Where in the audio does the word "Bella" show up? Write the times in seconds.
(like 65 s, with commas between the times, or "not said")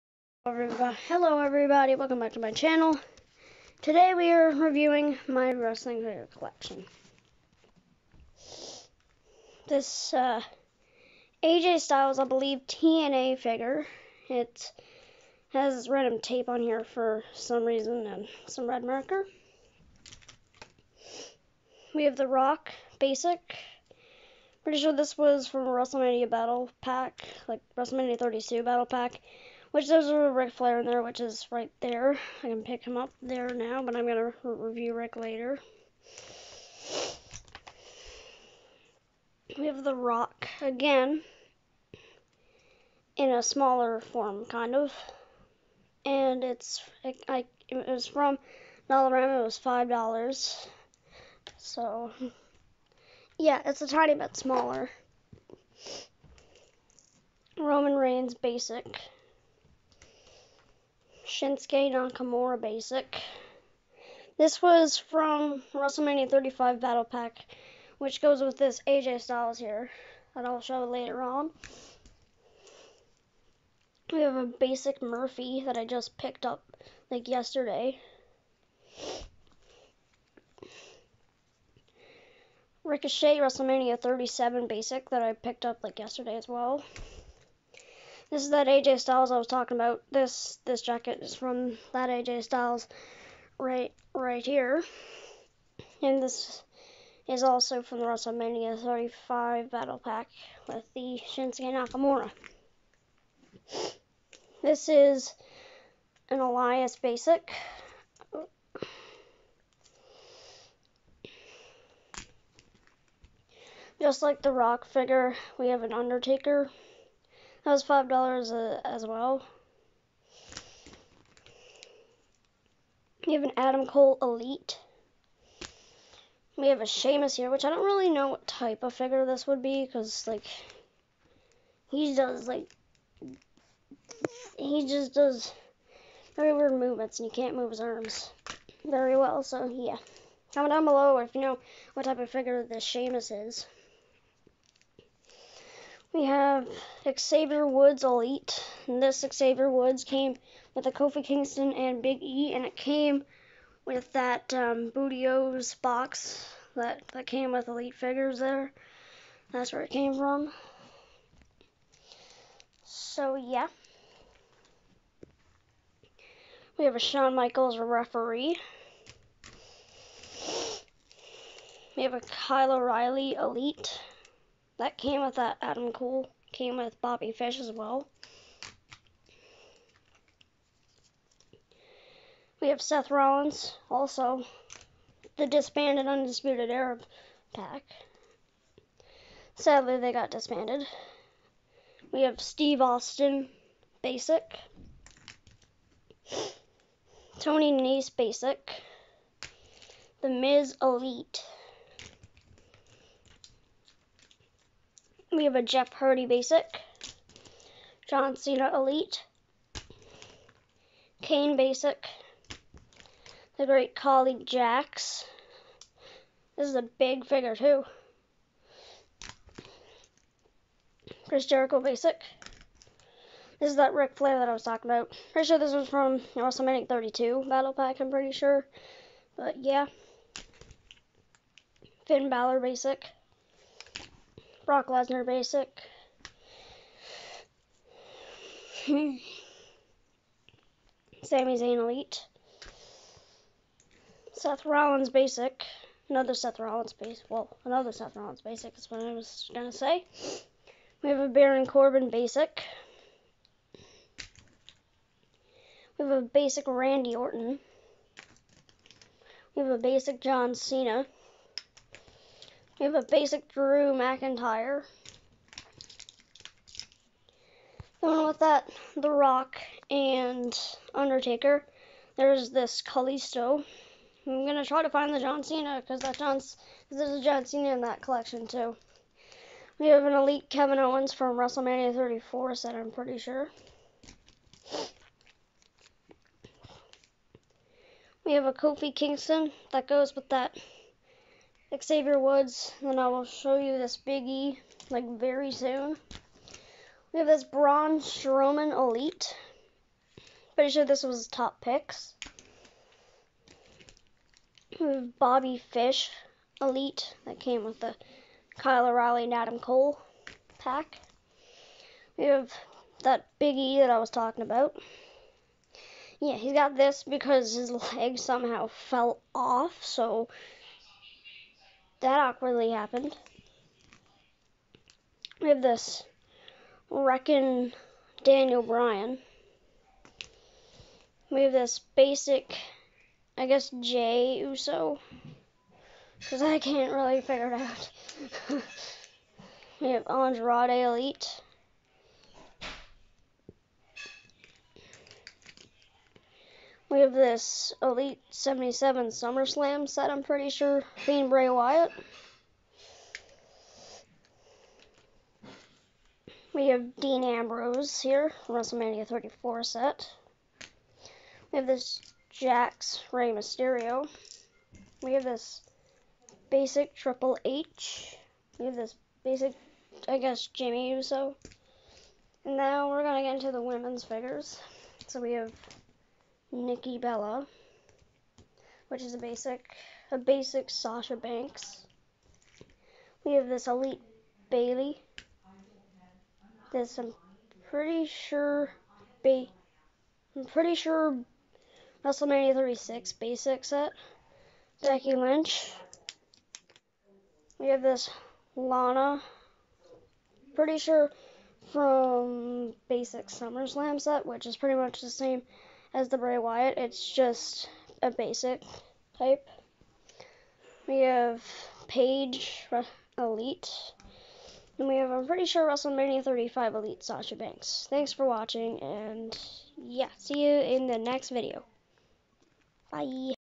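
376 s.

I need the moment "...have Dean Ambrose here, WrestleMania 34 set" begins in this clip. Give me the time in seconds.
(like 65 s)
356 s.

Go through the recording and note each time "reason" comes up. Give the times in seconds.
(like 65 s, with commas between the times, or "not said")
17 s.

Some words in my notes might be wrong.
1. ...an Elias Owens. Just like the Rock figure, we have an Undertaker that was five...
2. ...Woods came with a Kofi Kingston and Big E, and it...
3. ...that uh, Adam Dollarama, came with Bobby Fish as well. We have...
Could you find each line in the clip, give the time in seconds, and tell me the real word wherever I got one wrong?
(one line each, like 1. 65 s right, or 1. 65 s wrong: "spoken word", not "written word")
1. 106 s wrong: "Basic", not "Owens"
2. 149 s right
3. 175 s wrong: "Cole", not "Dollarama".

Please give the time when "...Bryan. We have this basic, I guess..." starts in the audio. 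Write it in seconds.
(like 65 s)
328 s.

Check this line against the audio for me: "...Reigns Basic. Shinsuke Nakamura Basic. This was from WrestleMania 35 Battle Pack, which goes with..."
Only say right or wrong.
right.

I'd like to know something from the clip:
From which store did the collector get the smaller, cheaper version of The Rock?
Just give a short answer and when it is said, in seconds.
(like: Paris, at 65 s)
Dollarama, at 48 s.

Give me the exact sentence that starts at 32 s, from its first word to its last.
I can pick him up there now, but I'm gonna review Ric later.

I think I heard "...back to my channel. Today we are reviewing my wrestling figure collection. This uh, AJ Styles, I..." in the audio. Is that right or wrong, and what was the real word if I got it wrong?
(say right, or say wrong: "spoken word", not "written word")
right.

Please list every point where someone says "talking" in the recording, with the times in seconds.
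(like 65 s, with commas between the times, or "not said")
89 s, 224 s, 314 s.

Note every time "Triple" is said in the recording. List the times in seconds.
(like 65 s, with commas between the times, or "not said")
366 s.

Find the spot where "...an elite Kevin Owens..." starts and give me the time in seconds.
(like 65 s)
280 s.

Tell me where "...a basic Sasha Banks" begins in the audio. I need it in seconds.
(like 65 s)
380 s.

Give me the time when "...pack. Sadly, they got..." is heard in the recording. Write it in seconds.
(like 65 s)
187 s.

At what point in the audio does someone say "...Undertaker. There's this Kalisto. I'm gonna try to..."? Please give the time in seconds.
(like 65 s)
270 s.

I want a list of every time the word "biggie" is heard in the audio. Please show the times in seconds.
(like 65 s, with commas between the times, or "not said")
293 s, 313 s.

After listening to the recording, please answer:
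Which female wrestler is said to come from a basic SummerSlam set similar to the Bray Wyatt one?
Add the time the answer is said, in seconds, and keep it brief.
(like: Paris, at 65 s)
Lana, at 398 s.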